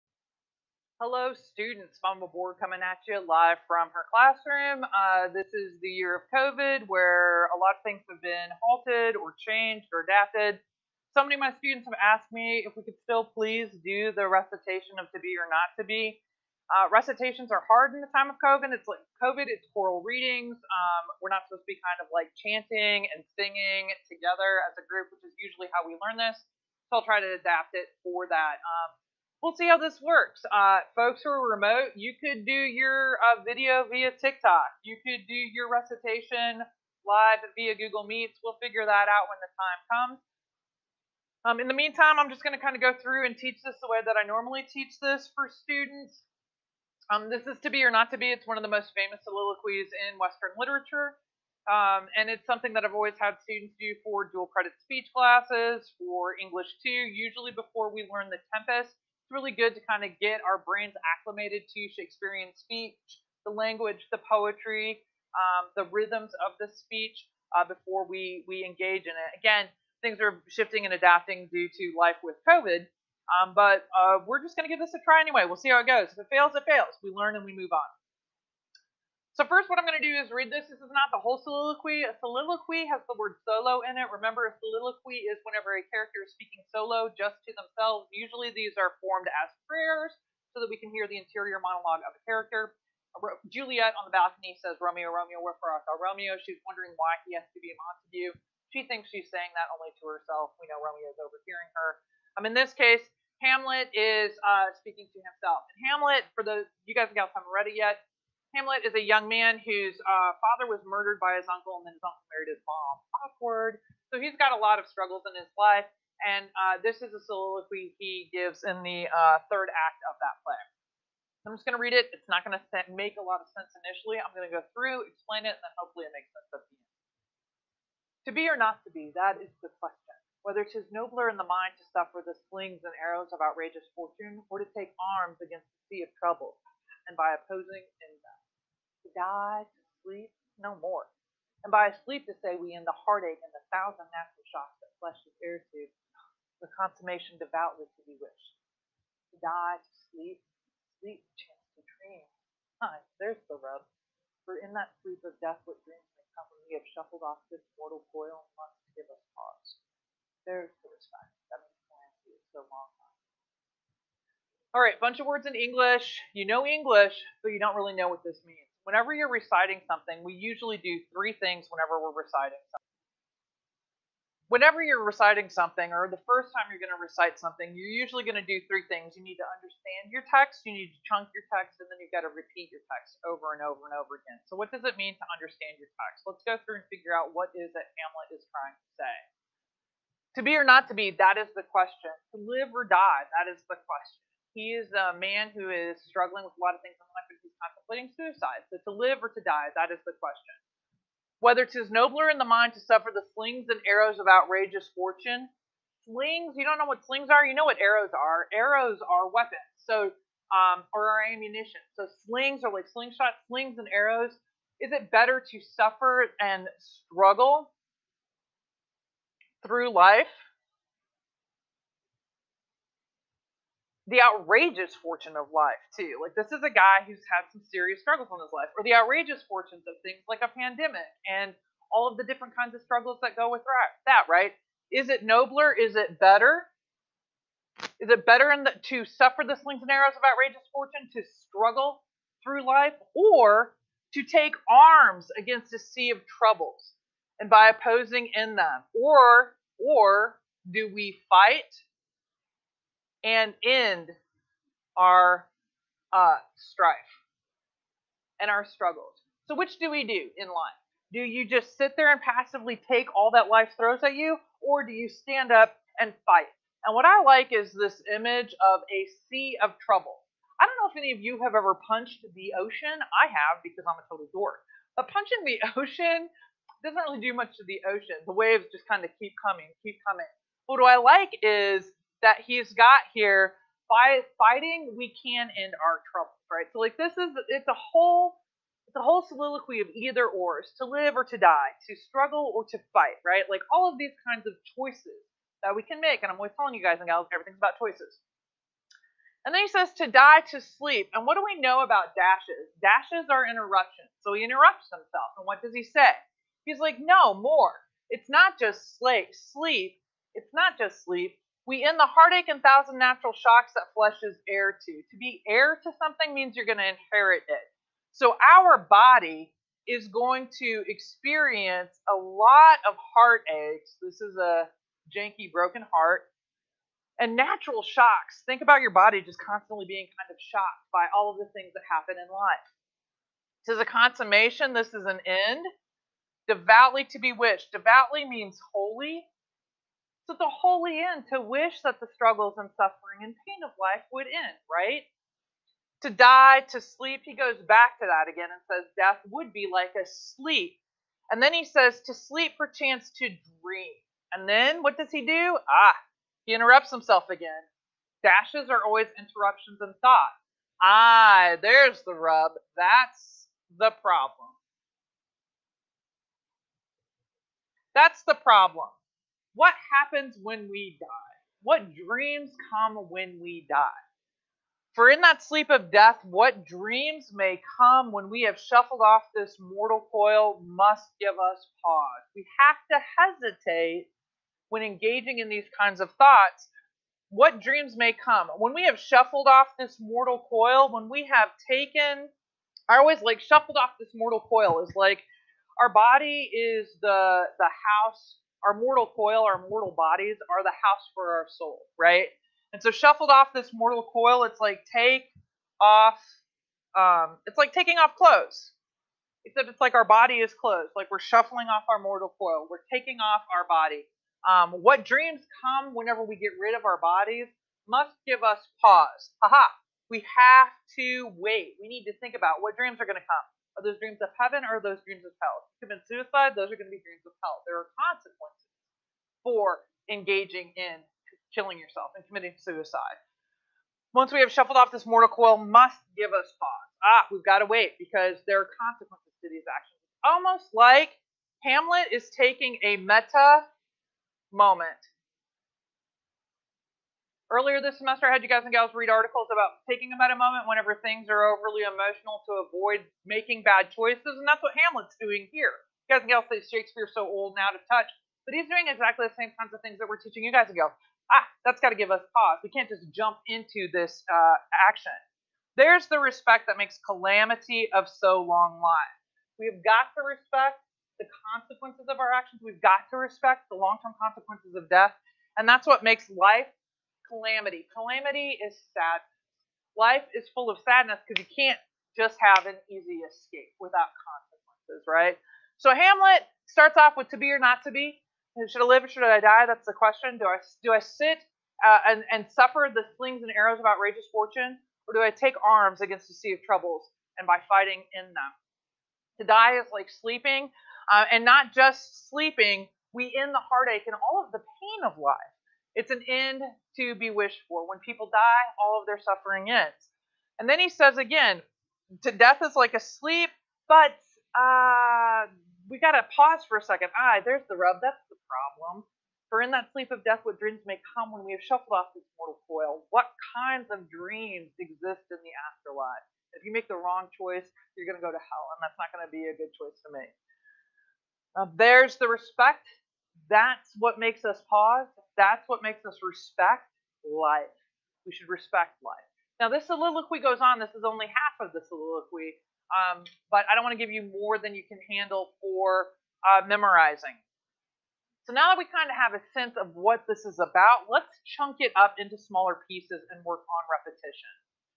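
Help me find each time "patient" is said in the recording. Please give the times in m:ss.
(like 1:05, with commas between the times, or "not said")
not said.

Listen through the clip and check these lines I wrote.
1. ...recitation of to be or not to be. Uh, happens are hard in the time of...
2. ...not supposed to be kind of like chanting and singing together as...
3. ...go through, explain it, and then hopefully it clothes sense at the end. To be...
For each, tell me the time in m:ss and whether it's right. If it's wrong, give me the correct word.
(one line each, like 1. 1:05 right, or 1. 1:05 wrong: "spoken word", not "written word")
1. 0:14 wrong: "recitations", not "happens"
2. 0:21 right
3. 2:04 wrong: "makes", not "clothes".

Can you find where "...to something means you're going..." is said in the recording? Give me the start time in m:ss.
5:15.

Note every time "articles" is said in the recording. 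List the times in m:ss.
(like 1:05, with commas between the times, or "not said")
7:29.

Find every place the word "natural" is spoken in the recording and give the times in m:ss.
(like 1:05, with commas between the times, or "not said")
2:24, 5:12, 5:27.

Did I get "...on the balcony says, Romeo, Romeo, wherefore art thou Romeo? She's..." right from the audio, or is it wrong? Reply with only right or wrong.
right.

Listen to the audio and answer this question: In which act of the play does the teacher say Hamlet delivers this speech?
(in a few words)
Third act.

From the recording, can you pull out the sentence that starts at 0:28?
Um, we'll see how this works.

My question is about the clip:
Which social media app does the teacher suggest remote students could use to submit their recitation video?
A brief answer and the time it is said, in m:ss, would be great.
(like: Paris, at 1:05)
TikTok, at 0:34.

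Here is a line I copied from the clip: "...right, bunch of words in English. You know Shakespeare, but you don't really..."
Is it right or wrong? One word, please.
wrong.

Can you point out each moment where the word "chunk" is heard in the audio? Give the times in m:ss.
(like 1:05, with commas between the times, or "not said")
3:01, 9:11.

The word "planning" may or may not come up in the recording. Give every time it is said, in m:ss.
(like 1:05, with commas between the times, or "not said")
2:41.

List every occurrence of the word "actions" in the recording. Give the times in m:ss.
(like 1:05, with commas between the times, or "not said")
7:19, 7:44, 7:52.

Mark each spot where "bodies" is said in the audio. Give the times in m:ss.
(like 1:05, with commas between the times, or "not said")
6:39, 6:57.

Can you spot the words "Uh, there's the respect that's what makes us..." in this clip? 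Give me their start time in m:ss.
8:51.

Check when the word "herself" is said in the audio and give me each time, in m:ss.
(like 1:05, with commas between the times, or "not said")
1:40.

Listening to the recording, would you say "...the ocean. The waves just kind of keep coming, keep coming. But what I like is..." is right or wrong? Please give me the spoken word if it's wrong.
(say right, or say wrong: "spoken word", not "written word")
right.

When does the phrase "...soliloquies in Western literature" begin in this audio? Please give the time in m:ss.
0:49.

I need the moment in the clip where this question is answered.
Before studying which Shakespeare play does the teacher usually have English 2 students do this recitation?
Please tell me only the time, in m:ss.
0:58.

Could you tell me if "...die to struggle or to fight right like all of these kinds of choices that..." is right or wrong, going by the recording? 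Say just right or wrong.
right.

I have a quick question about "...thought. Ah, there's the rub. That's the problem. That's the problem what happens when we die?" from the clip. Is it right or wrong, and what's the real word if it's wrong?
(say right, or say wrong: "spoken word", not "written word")
right.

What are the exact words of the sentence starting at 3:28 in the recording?
Arrows are weapons, so um, or are ammunition.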